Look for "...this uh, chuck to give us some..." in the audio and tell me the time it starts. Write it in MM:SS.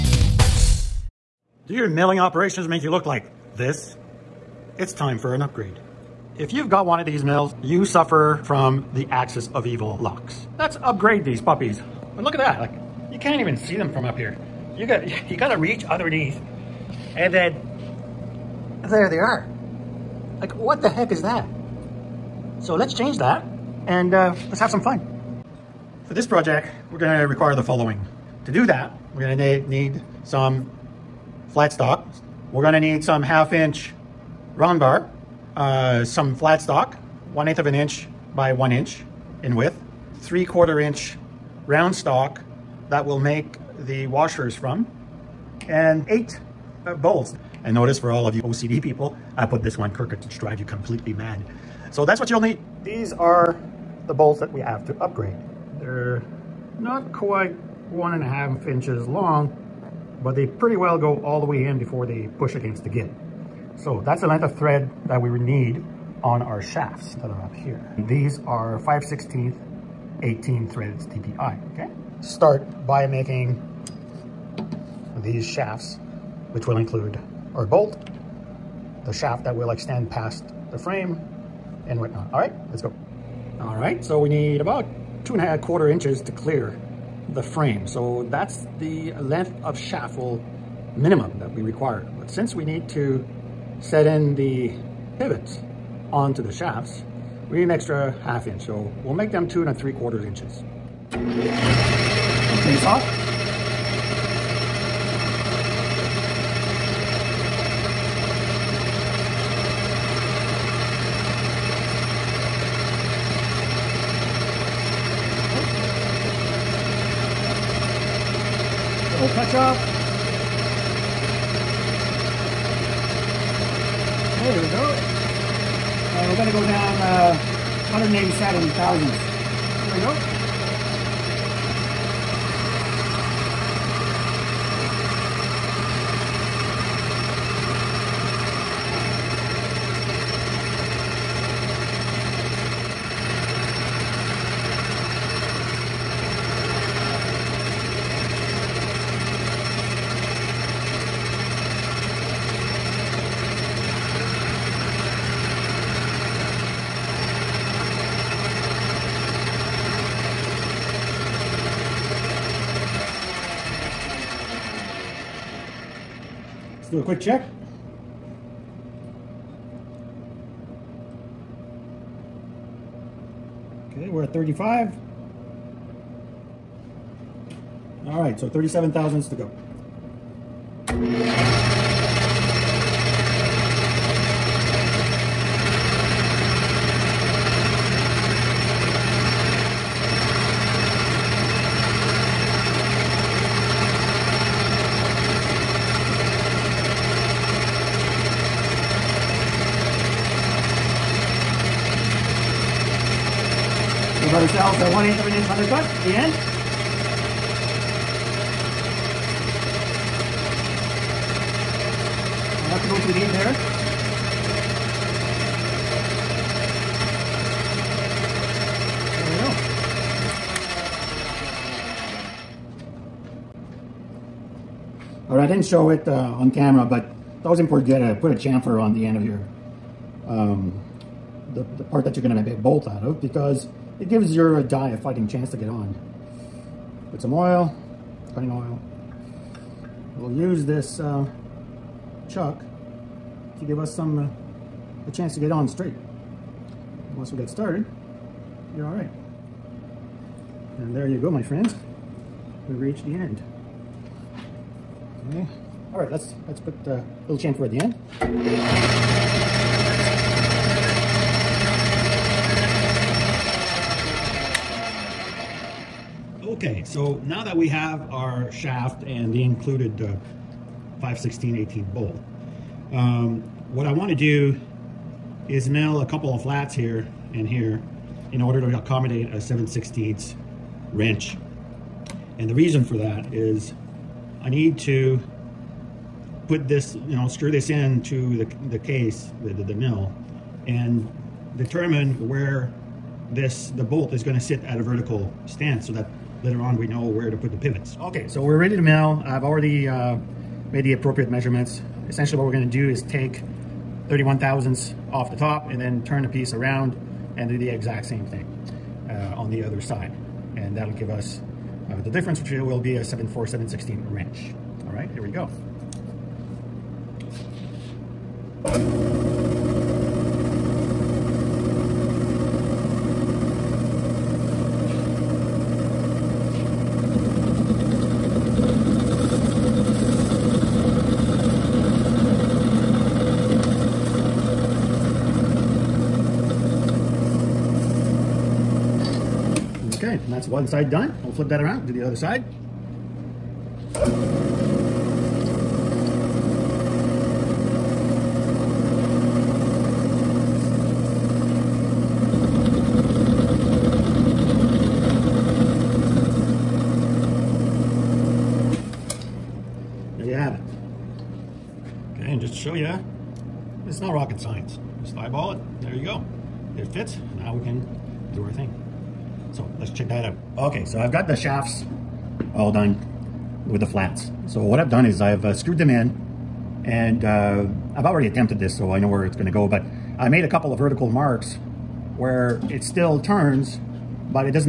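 04:00.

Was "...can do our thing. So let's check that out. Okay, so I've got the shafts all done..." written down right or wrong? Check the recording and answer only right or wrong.
right.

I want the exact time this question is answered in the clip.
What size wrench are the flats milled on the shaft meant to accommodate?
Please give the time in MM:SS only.
04:39.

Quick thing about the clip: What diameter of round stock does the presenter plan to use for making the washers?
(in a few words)
3/4 inch.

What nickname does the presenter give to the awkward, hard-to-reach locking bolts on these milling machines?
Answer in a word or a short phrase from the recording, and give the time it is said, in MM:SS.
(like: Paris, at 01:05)
axis of evil locks, at 00:09.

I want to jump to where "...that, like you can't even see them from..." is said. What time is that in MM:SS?
00:12.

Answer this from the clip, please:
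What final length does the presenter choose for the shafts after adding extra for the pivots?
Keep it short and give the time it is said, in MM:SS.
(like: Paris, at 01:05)
2 3/4 inches, at 01:39.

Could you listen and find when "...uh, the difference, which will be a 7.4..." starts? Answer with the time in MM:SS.
05:11.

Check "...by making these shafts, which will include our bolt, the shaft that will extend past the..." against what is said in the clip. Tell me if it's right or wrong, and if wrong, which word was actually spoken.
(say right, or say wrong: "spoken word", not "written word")
right.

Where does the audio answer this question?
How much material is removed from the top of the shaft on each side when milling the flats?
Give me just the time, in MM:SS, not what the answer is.
05:04.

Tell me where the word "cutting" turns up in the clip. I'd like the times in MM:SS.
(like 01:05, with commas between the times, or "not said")
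03:58.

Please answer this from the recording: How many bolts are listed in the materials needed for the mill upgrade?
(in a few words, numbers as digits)
8.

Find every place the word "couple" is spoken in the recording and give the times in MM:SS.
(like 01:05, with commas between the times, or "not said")
04:36, 06:20.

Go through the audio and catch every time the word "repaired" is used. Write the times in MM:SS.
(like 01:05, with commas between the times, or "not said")
not said.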